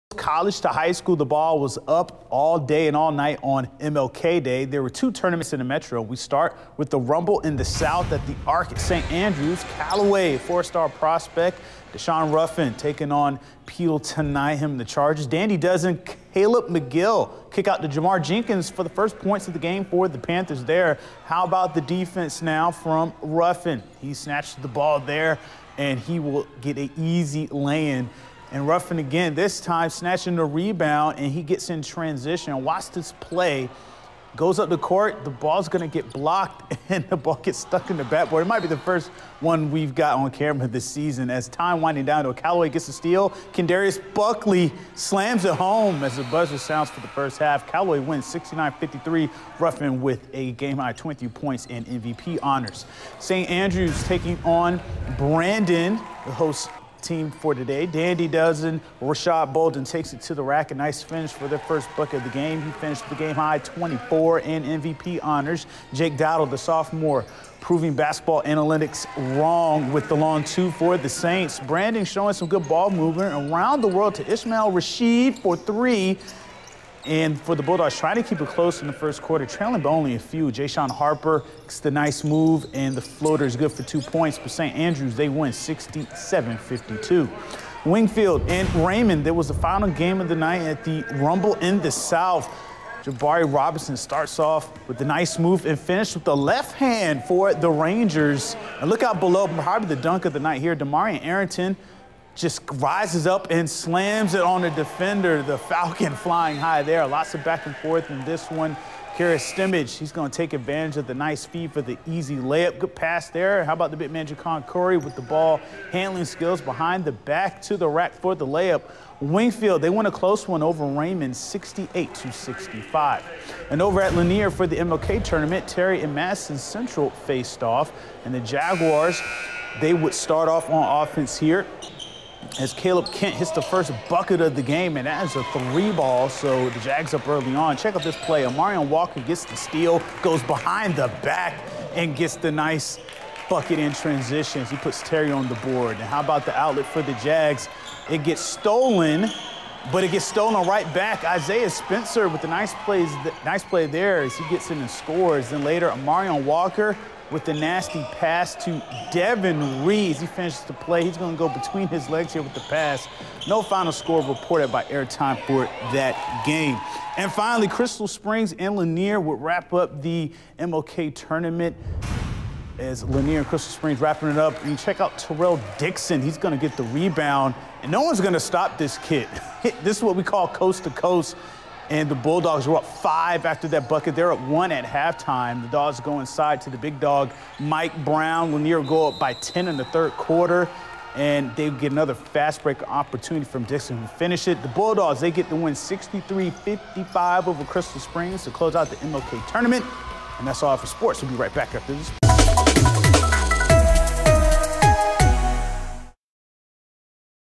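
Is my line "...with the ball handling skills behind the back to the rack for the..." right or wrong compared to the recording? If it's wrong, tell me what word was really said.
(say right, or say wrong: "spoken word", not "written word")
right.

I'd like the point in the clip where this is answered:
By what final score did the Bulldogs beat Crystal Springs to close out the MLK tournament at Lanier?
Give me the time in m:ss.
3:15.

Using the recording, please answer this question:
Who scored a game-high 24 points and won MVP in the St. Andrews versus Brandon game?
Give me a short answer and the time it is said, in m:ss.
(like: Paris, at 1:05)
Rashad Bolden, at 0:59.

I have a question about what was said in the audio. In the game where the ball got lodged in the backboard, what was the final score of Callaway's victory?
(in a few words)
69-53.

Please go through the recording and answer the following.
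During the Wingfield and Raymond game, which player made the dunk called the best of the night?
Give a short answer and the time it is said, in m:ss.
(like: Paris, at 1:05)
Demarion Arrington, at 1:40.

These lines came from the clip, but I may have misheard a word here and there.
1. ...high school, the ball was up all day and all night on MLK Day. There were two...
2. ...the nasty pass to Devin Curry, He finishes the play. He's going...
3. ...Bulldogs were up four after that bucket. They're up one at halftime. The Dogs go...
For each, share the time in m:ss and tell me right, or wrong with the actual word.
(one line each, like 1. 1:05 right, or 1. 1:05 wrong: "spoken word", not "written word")
1. 0:00 right
2. 2:37 wrong: "Reed", not "Curry"
3. 3:02 wrong: "five", not "four".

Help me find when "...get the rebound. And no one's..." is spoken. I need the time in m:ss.
2:56.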